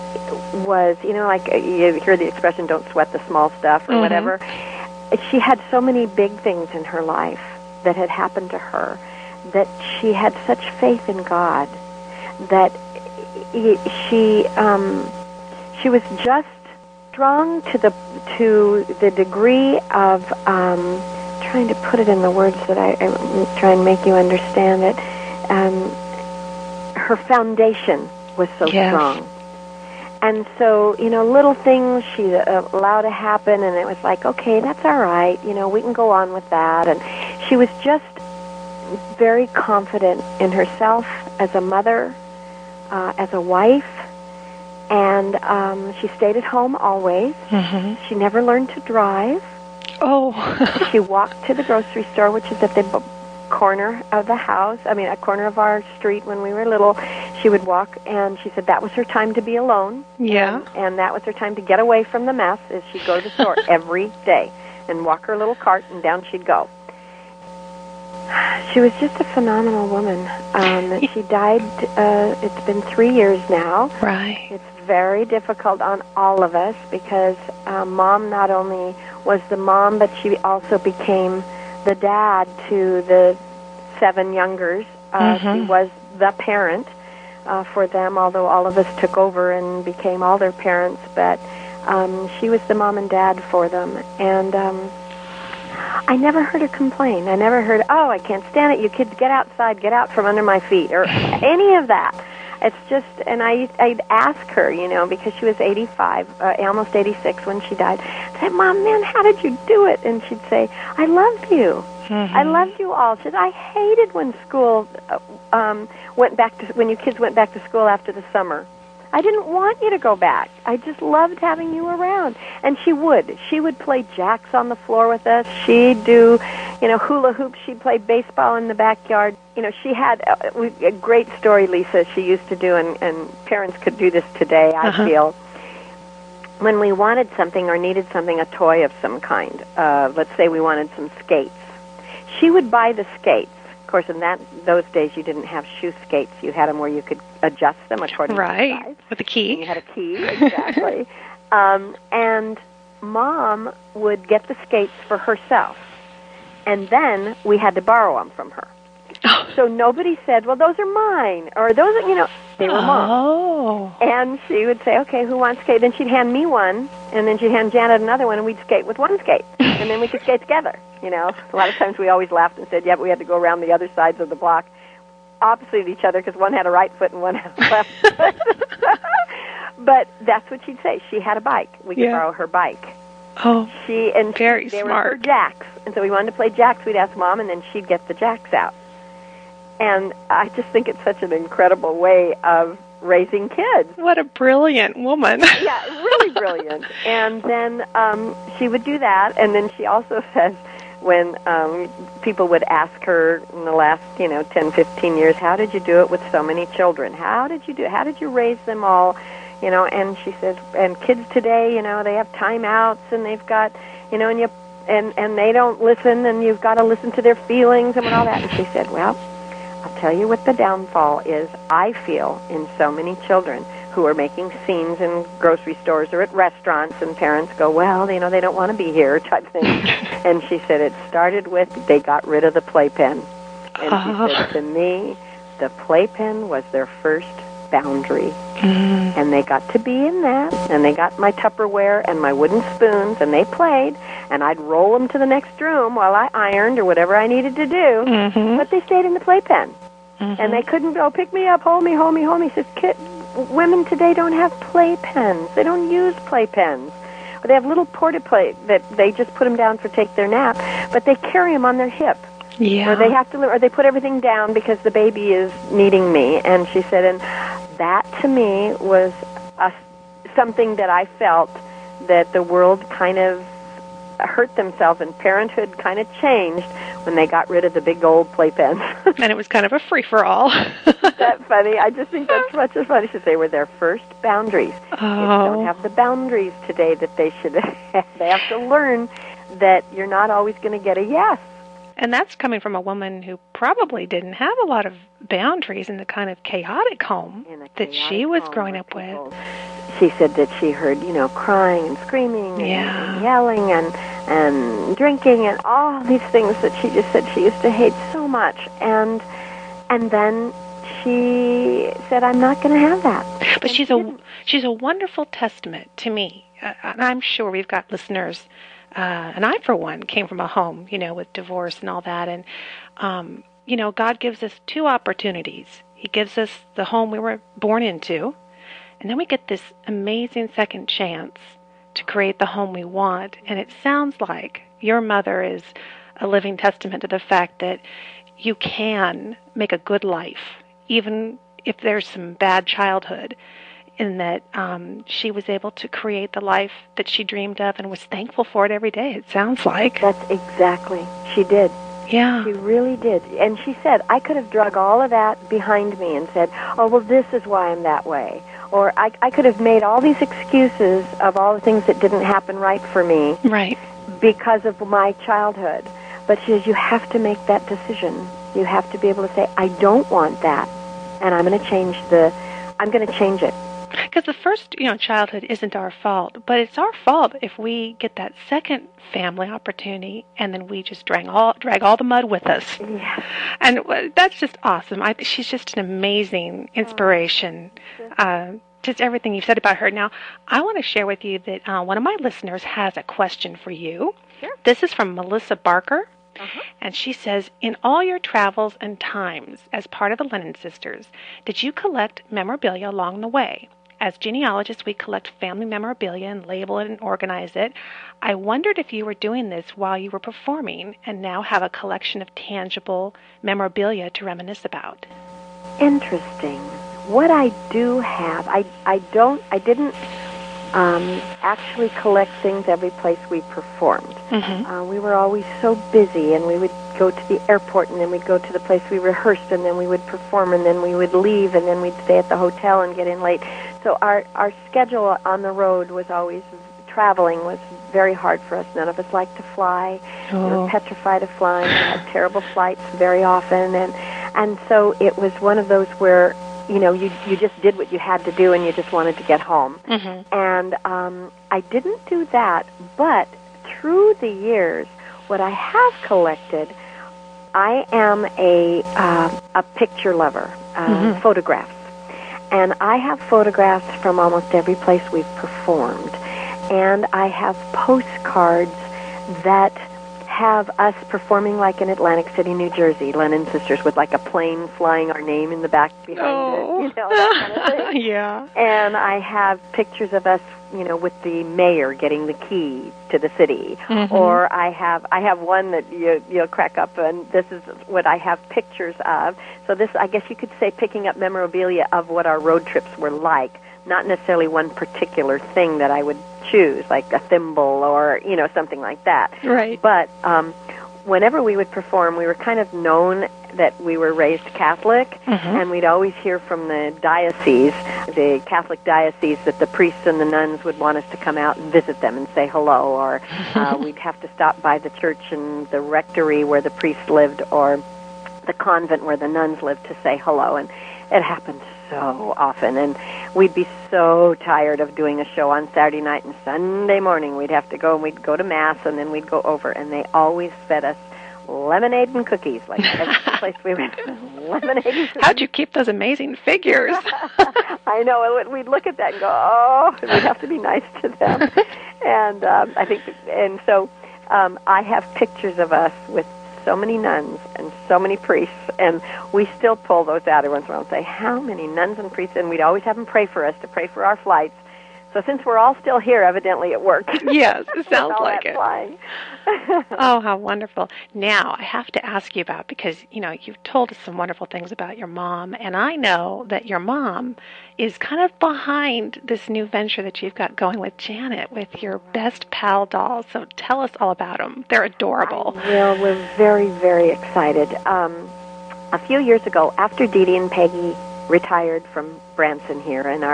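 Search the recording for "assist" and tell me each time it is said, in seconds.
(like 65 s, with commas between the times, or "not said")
not said.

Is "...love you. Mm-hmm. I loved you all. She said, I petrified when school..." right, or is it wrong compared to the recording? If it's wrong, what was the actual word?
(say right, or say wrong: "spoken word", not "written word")
wrong: "hated", not "petrified".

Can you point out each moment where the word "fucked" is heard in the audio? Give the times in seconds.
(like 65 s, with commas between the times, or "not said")
not said.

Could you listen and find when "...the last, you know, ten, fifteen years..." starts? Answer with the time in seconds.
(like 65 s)
203 s.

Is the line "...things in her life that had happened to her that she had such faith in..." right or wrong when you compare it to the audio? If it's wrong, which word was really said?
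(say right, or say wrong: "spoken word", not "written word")
right.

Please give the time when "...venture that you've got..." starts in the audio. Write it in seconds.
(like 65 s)
569 s.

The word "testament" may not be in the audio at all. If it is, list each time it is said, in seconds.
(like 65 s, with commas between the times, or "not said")
315 s, 336 s.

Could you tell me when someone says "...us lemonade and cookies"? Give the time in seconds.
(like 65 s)
530 s.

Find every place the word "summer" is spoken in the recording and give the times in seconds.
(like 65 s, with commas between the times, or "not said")
118 s.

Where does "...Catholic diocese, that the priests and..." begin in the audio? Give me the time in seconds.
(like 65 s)
508 s.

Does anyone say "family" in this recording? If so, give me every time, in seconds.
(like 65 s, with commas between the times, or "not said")
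379 s, 405 s.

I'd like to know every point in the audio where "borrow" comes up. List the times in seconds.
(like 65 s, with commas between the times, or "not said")
157 s, 182 s.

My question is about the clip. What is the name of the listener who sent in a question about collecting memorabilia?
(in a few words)
Melissa Barker.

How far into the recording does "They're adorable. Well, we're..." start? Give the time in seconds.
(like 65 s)
574 s.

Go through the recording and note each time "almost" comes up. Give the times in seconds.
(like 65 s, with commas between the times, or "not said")
106 s, 464 s.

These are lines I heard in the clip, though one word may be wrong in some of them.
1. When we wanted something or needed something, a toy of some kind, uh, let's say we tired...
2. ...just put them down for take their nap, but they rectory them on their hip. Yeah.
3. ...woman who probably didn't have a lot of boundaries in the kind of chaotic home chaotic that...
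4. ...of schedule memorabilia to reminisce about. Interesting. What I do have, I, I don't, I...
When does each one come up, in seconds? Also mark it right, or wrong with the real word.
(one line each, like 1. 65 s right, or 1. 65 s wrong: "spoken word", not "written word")
1. 136 s wrong: "wanted", not "tired"
2. 259 s wrong: "carry", not "rectory"
3. 292 s right
4. 412 s wrong: "tangible", not "schedule".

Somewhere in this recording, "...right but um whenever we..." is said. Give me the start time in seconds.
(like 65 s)
499 s.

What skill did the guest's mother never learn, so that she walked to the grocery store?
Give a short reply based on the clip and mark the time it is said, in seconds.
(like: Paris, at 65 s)
Drive, at 48 s.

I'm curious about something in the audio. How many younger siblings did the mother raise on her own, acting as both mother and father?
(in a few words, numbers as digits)
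7.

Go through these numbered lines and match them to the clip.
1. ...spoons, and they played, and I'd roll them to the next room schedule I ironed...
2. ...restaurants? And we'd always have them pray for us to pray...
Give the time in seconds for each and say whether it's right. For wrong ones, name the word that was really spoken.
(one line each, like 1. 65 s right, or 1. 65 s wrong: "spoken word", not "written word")
1. 242 s wrong: "while", not "schedule"
2. 552 s wrong: "priests", not "restaurants".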